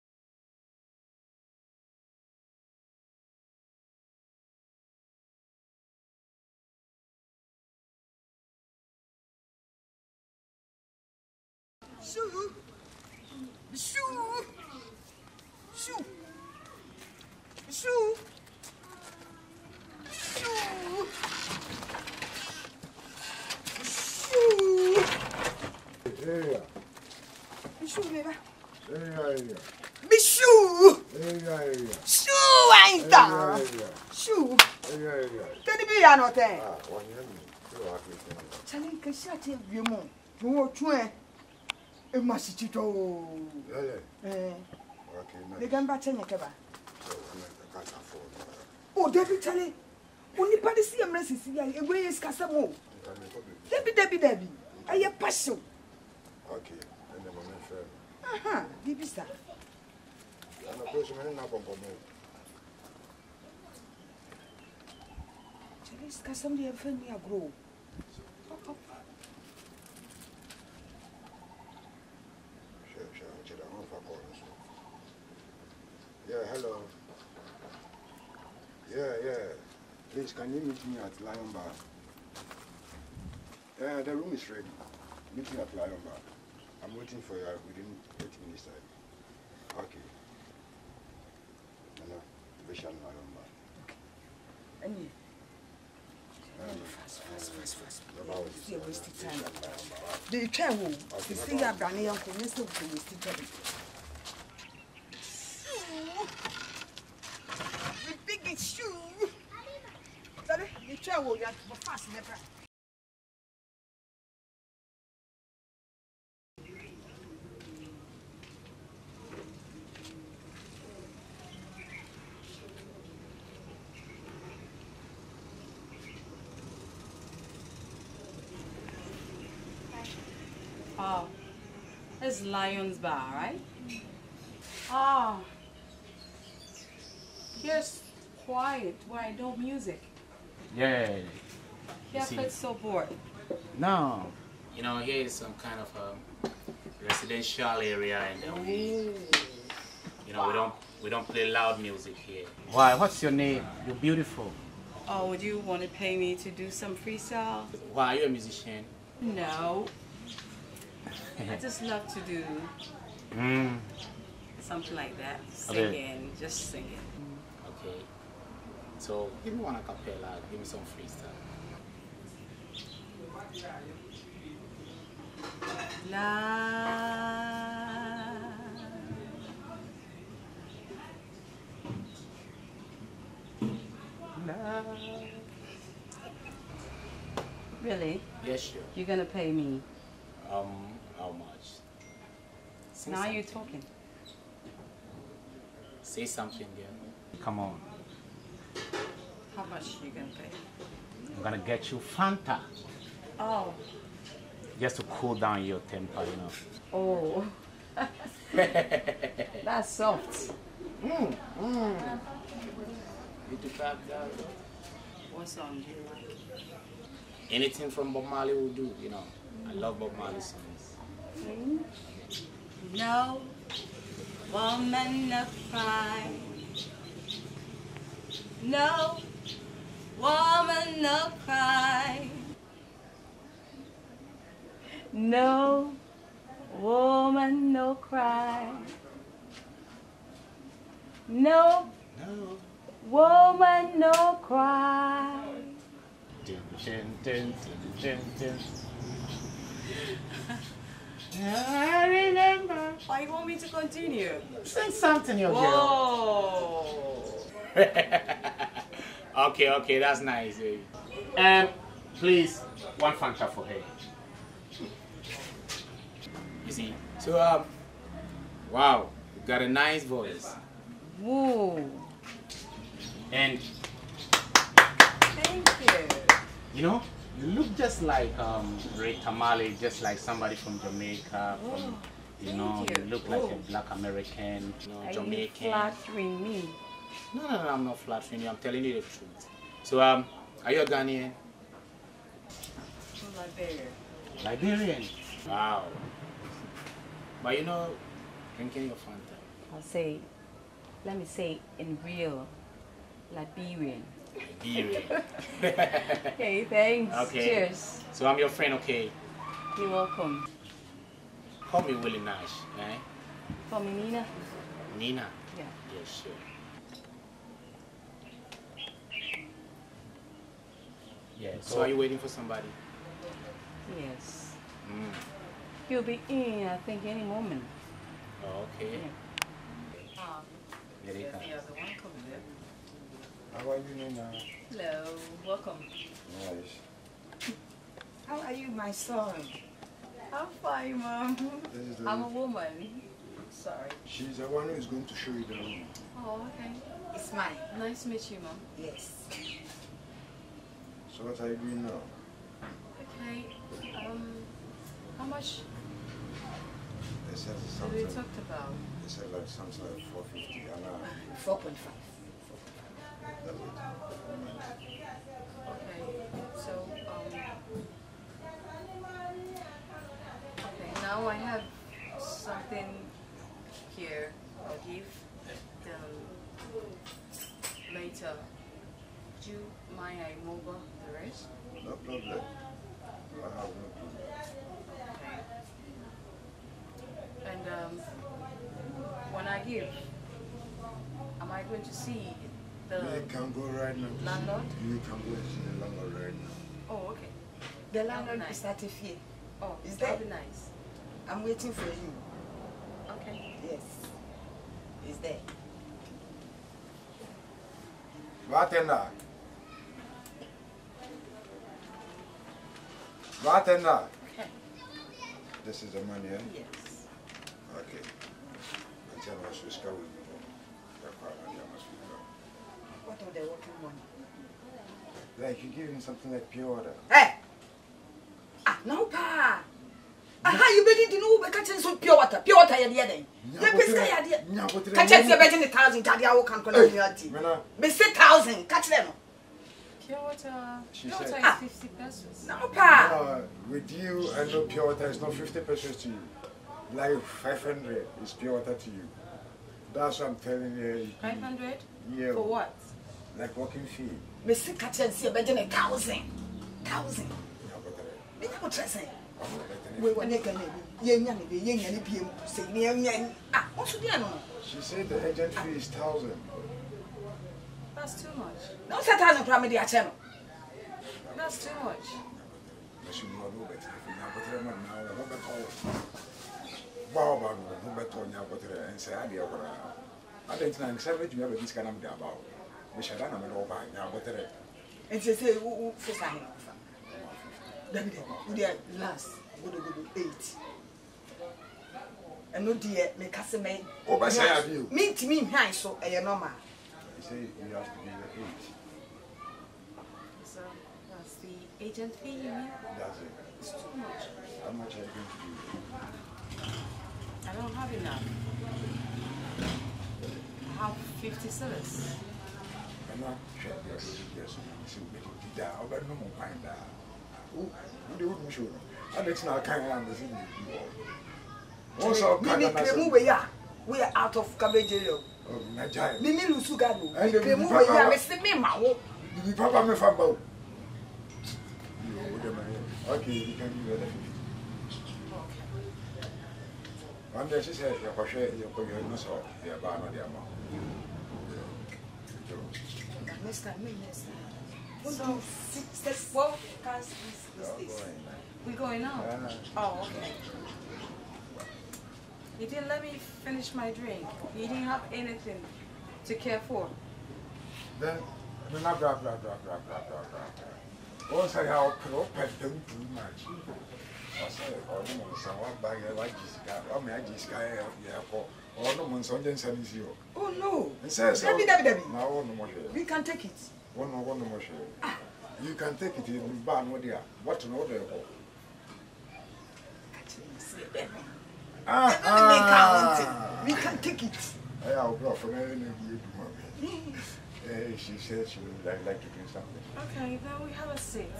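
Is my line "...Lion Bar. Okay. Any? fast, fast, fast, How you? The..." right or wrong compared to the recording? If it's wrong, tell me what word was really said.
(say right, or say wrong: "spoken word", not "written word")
wrong: "And", not "How".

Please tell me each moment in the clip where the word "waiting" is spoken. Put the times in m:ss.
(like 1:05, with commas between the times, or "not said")
1:26, 5:21, 6:41.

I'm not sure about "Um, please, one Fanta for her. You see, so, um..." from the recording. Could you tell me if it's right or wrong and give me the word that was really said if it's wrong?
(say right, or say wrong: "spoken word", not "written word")
right.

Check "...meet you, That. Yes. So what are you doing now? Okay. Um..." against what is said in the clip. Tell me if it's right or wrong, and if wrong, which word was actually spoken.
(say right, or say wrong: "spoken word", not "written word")
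wrong: "Mom", not "That".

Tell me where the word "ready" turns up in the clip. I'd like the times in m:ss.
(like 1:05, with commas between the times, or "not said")
1:24.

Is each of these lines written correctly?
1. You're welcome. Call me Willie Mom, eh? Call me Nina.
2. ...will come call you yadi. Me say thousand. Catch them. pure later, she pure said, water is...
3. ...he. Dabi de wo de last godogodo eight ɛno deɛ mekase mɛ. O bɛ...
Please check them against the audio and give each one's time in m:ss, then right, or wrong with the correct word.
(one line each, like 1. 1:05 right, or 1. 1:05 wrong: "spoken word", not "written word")
1. 5:09 wrong: "Nash", not "Mom"
2. 7:16 wrong: "water", not "later"
3. 8:06 right.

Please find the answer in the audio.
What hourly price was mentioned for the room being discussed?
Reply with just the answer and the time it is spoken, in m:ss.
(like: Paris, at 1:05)
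450, at 6:00.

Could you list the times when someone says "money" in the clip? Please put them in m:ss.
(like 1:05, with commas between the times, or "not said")
6:56, 7:03.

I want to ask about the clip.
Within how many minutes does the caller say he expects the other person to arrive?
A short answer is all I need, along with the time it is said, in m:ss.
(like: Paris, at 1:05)
30 minutes, at 1:28.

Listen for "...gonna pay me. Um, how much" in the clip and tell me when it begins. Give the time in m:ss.
3:09.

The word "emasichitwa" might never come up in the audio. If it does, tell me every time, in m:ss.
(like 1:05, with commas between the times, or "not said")
0:42.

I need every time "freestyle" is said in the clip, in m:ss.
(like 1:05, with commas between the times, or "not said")
2:36, 2:50.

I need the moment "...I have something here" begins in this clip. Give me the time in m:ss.
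6:11.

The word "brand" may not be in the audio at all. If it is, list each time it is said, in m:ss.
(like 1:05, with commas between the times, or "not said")
1:41.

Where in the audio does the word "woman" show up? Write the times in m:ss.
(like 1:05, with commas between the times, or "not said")
3:44, 3:50, 3:56, 4:03, 5:42.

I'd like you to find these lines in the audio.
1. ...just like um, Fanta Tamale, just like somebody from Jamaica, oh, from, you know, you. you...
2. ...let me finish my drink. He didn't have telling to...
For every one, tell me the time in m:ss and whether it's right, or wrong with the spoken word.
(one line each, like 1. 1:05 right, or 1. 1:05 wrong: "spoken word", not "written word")
1. 4:37 wrong: "Ray", not "Fanta"
2. 9:12 wrong: "anything", not "telling".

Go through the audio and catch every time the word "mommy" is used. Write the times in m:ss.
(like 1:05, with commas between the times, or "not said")
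9:46.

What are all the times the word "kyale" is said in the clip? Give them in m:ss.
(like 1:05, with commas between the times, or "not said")
0:49, 1:05.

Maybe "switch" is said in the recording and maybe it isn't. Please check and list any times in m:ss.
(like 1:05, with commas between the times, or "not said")
6:59.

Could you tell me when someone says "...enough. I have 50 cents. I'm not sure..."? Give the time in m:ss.
8:27.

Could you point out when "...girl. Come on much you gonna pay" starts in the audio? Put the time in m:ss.
3:16.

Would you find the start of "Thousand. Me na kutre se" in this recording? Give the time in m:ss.
7:36.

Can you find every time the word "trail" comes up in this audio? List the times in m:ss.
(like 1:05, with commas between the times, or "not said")
not said.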